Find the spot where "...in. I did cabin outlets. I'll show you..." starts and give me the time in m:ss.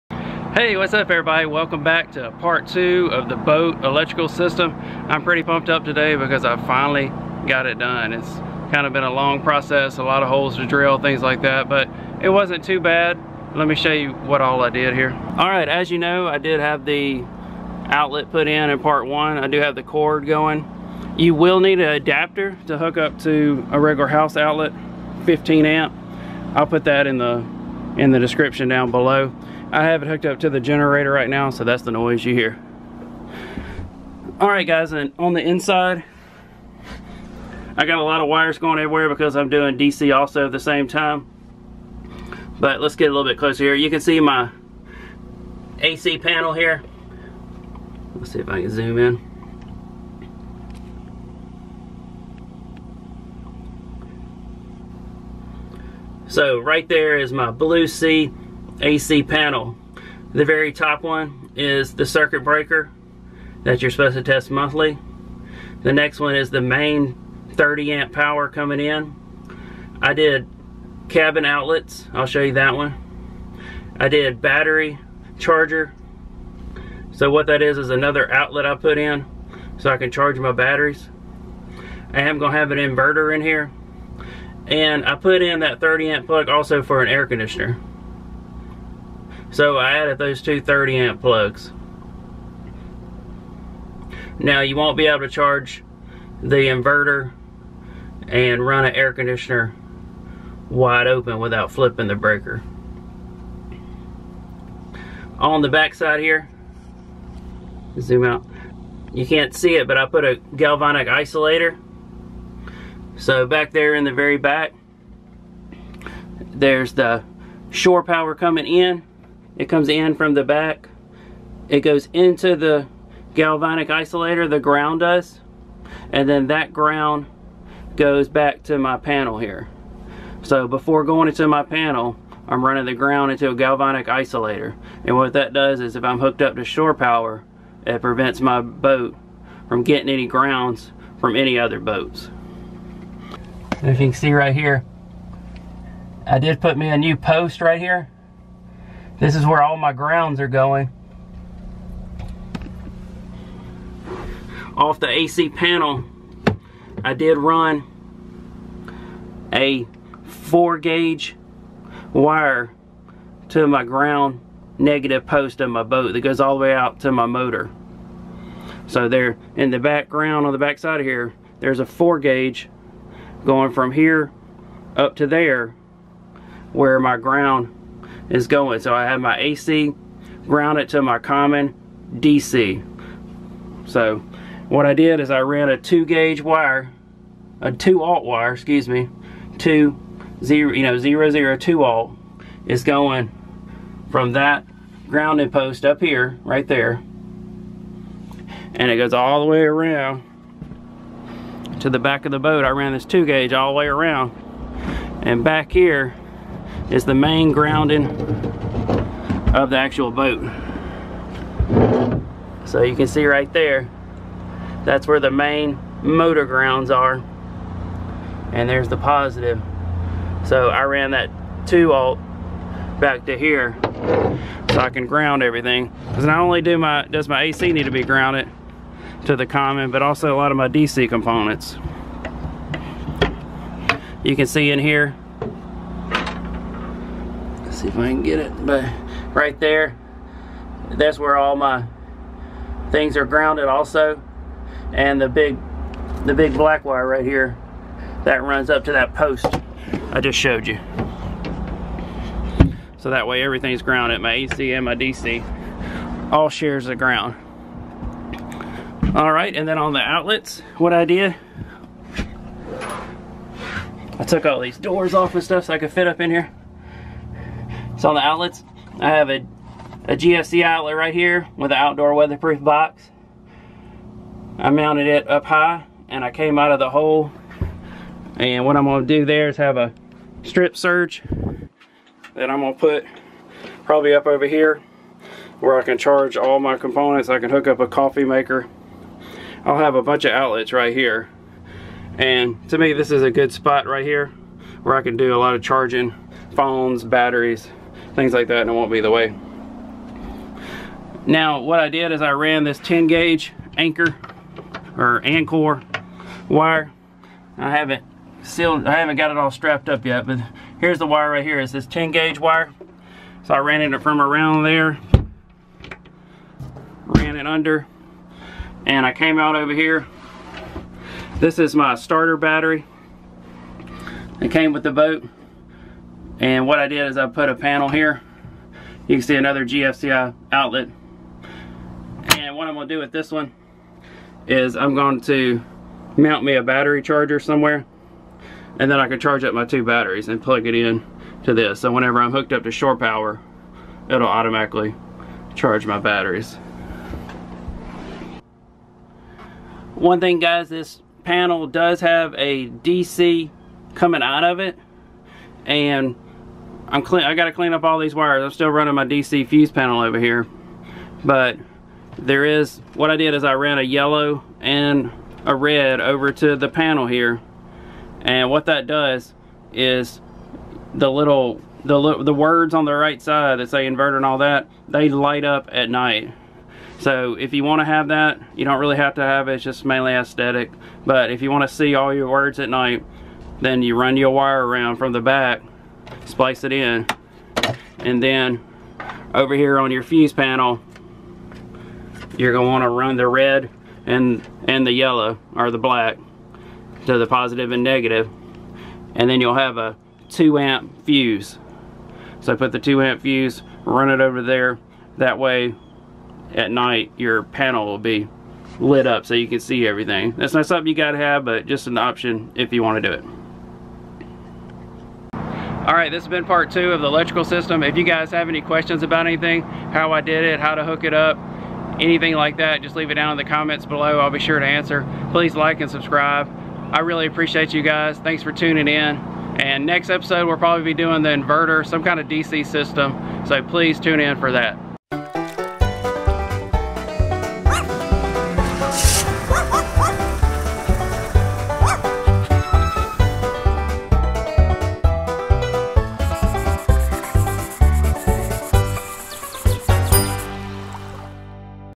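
1:08.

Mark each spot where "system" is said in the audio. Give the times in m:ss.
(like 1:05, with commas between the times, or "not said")
0:04, 6:57, 7:12.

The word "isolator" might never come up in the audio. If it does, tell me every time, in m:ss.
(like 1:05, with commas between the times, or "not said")
1:51, 2:03, 2:14.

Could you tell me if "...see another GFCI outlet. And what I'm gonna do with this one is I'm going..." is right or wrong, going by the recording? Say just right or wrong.
right.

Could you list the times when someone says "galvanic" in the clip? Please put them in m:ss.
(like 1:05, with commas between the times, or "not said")
1:50, 2:03, 2:13.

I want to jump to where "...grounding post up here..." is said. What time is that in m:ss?
3:15.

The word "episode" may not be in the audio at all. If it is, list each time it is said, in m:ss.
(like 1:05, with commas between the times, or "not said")
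7:10.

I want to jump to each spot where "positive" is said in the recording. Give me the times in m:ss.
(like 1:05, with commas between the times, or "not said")
3:38, 6:37.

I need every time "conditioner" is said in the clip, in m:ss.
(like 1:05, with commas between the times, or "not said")
1:27, 1:39.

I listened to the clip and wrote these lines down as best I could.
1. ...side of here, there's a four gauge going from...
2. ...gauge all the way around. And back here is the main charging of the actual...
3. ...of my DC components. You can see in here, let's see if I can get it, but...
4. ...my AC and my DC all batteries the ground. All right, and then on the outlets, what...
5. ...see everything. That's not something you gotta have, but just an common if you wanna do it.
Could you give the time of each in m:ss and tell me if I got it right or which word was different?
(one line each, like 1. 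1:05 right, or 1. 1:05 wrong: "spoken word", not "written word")
1. 2:50 right
2. 3:23 wrong: "grounding", not "charging"
3. 3:50 right
4. 4:14 wrong: "shares", not "batteries"
5. 6:49 wrong: "option", not "common".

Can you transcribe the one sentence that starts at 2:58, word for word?
So I have my AC grounded to my common DC.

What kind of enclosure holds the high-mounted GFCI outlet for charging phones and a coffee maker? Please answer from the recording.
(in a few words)
outdoor weatherproof box.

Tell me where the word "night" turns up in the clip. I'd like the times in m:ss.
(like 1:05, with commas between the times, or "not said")
6:15, 6:22, 6:46.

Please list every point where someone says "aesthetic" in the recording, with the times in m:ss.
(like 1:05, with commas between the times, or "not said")
6:20.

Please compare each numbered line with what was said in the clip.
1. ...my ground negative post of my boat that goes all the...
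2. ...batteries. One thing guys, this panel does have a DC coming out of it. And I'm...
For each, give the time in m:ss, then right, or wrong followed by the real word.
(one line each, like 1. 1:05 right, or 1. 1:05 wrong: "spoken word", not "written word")
1. 2:43 right
2. 5:45 right.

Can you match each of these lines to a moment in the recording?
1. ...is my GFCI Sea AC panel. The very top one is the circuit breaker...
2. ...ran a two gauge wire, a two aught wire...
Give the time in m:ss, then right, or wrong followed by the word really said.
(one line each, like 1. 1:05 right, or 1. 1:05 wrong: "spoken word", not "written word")
1. 0:57 wrong: "Blue", not "GFCI"
2. 3:05 right.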